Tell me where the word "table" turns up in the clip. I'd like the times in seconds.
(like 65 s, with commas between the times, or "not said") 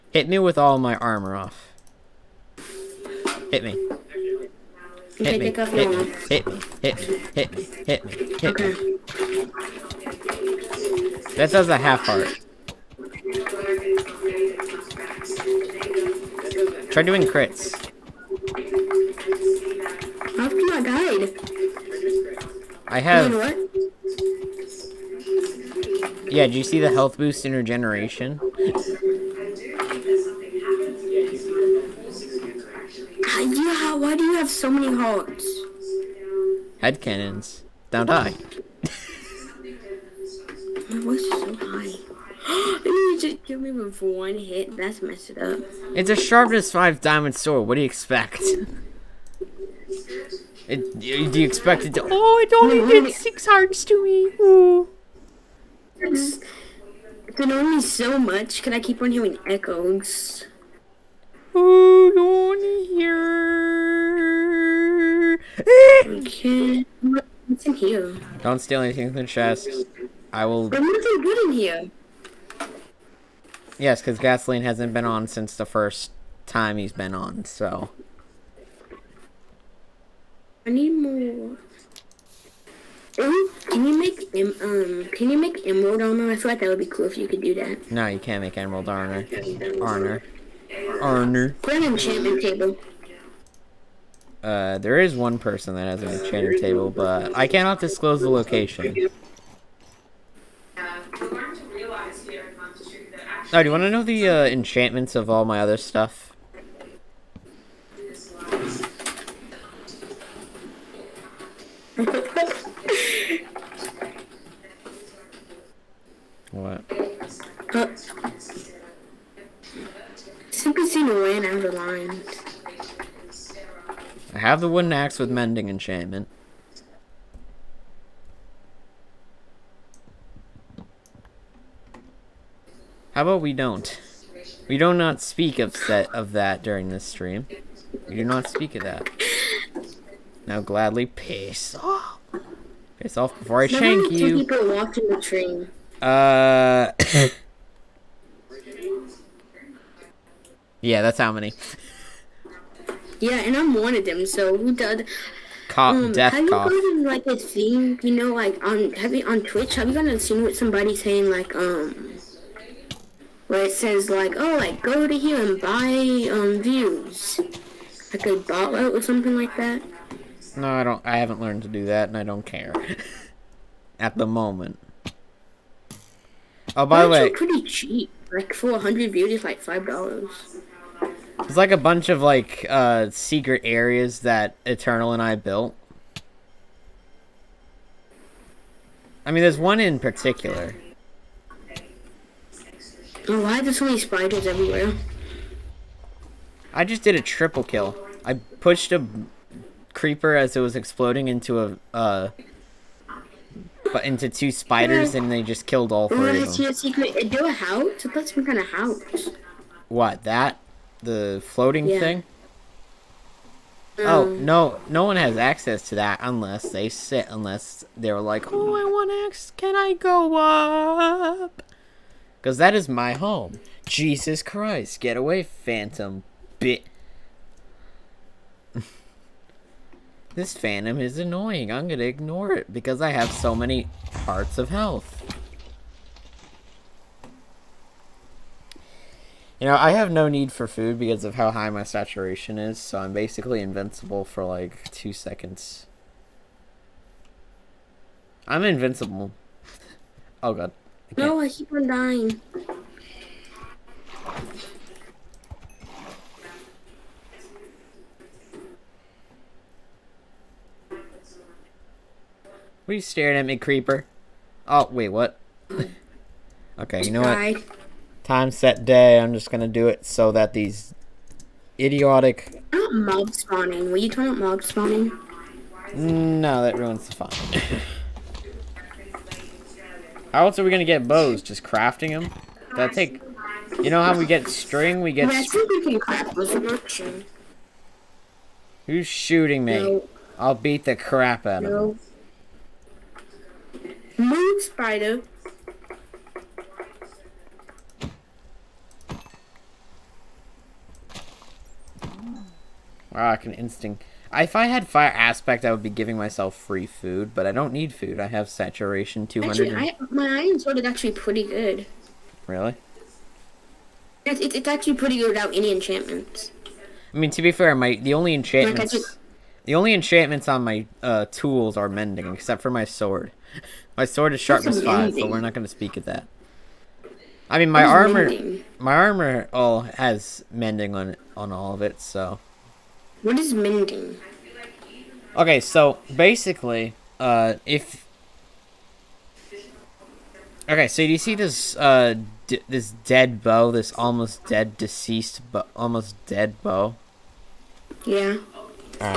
92 s, 96 s.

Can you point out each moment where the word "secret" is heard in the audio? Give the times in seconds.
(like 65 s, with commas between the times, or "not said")
183 s, 206 s.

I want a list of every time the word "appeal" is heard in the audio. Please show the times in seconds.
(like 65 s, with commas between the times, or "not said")
not said.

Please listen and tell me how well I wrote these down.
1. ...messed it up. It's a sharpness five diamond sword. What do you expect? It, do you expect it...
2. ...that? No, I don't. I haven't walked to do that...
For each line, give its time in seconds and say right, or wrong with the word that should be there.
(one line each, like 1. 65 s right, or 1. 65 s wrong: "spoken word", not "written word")
1. 45 s right
2. 169 s wrong: "learned", not "walked".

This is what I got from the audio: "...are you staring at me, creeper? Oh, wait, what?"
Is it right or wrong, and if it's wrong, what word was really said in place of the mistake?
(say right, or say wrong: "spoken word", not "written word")
right.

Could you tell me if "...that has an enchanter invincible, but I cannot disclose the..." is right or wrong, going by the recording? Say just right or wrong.
wrong.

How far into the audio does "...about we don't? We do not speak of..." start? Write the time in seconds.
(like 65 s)
133 s.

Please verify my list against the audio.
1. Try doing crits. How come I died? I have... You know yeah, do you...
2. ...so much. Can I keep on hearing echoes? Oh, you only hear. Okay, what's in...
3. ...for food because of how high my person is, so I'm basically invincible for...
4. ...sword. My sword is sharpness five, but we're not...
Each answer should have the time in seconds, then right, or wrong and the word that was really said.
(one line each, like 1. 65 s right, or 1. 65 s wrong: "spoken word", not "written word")
1. 16 s right
2. 57 s right
3. 240 s wrong: "saturation", not "person"
4. 322 s right.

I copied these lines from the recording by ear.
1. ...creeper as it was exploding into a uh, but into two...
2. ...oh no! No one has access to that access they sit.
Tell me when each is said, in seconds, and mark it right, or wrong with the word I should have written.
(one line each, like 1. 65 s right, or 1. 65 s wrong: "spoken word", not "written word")
1. 199 s right
2. 214 s wrong: "unless", not "access".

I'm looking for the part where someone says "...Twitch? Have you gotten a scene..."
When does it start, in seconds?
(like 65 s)
159 s.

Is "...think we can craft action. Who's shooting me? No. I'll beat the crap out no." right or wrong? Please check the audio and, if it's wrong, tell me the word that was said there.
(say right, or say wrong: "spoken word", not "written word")
right.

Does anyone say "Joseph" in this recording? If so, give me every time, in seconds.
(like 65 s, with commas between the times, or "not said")
not said.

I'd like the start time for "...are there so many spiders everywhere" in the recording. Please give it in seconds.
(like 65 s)
193 s.